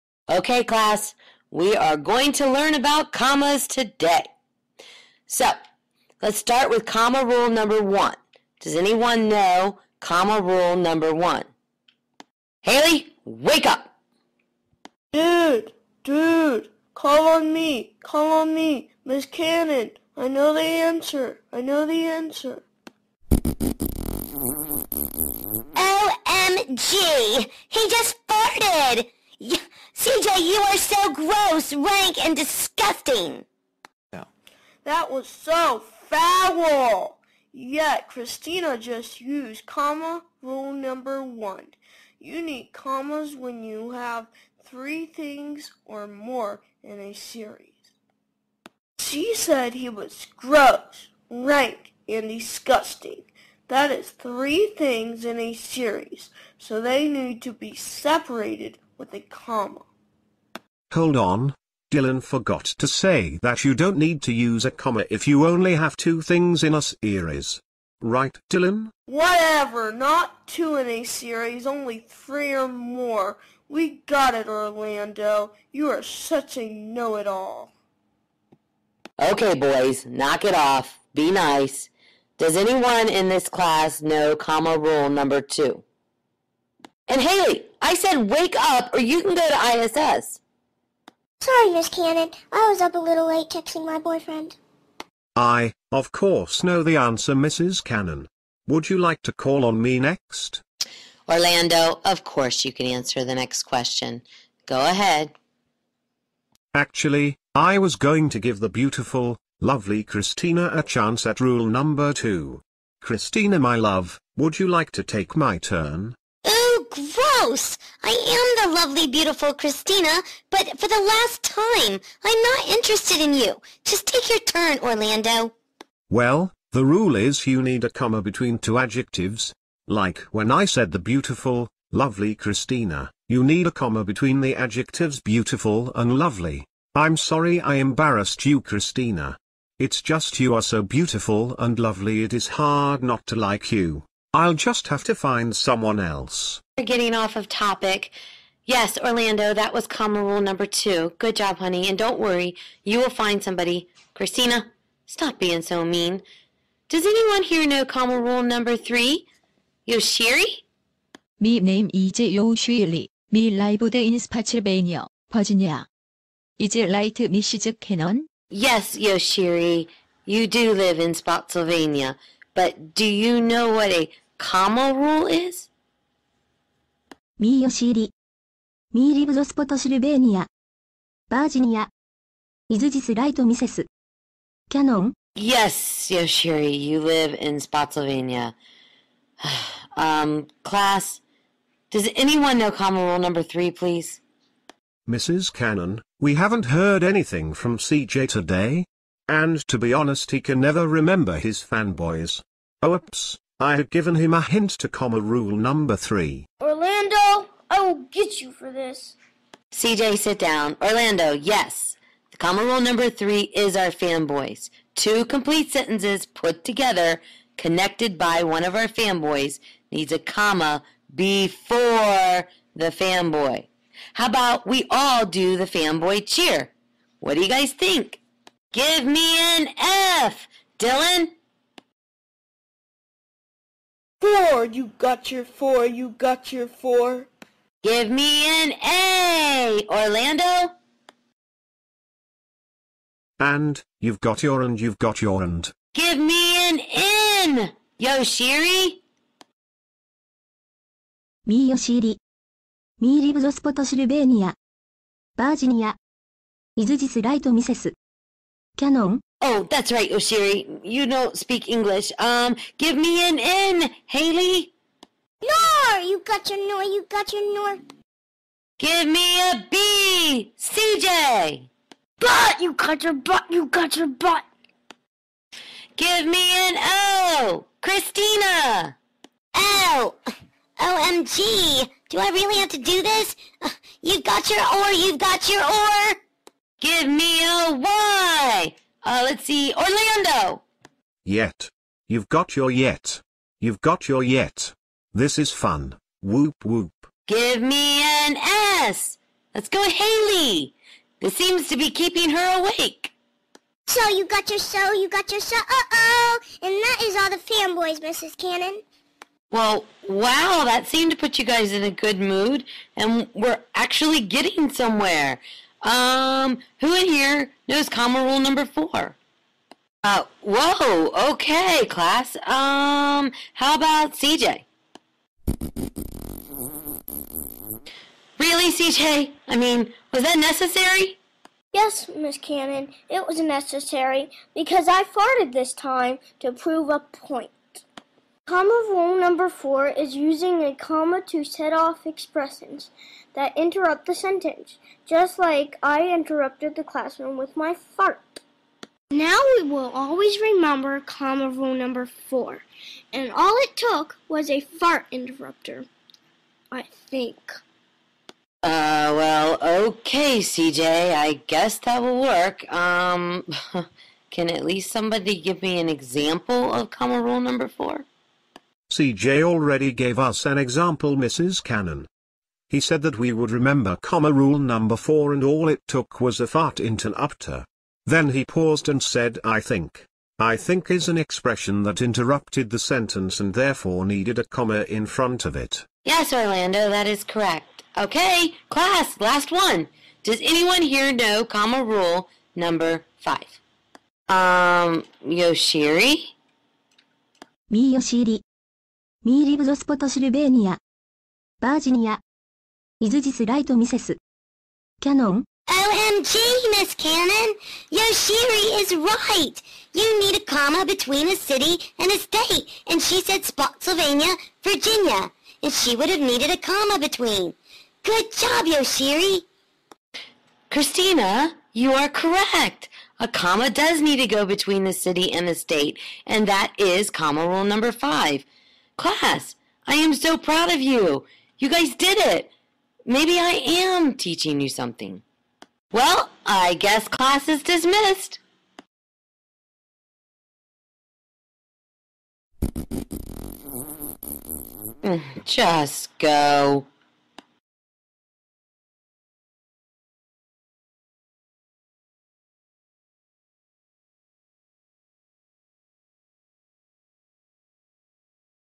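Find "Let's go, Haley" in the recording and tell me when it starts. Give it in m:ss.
4:59.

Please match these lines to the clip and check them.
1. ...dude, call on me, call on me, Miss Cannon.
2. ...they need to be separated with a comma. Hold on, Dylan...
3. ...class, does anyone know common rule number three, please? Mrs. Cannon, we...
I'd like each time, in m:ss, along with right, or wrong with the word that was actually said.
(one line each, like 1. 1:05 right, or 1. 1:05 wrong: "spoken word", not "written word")
1. 0:16 right
2. 0:56 right
3. 3:10 right.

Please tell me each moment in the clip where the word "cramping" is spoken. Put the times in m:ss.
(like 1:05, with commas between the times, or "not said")
not said.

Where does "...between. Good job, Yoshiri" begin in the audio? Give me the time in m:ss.
6:56.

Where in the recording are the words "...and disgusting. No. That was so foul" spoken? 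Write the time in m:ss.
0:32.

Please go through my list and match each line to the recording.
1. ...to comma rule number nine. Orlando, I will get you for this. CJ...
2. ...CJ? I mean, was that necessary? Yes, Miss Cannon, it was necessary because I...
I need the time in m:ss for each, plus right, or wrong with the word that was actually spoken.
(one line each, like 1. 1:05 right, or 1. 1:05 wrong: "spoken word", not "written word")
1. 3:24 wrong: "three", not "nine"
2. 5:28 right.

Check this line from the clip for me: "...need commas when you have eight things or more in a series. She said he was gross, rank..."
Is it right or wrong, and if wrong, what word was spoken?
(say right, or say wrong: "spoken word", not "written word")
wrong: "three", not "eight".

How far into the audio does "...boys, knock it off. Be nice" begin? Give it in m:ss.
1:19.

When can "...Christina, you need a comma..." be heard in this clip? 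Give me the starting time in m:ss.
2:12.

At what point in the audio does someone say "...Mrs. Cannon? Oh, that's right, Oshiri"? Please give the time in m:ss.
4:17.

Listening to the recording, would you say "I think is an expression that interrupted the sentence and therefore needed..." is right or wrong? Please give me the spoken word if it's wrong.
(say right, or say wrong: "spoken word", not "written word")
right.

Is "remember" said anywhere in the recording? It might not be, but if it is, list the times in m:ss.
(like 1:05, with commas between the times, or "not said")
3:20, 5:50, 6:13.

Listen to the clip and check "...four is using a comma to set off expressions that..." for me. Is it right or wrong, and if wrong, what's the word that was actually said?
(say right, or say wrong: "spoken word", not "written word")
right.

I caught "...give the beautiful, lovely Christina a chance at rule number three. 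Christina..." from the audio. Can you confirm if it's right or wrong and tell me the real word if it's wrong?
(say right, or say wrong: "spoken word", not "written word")
wrong: "two", not "three".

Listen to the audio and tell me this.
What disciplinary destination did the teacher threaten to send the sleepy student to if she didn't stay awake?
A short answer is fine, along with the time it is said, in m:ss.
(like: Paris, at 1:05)
ISS, at 1:30.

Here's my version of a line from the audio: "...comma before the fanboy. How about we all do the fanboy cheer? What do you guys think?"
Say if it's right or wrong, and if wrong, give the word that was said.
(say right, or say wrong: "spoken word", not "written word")
right.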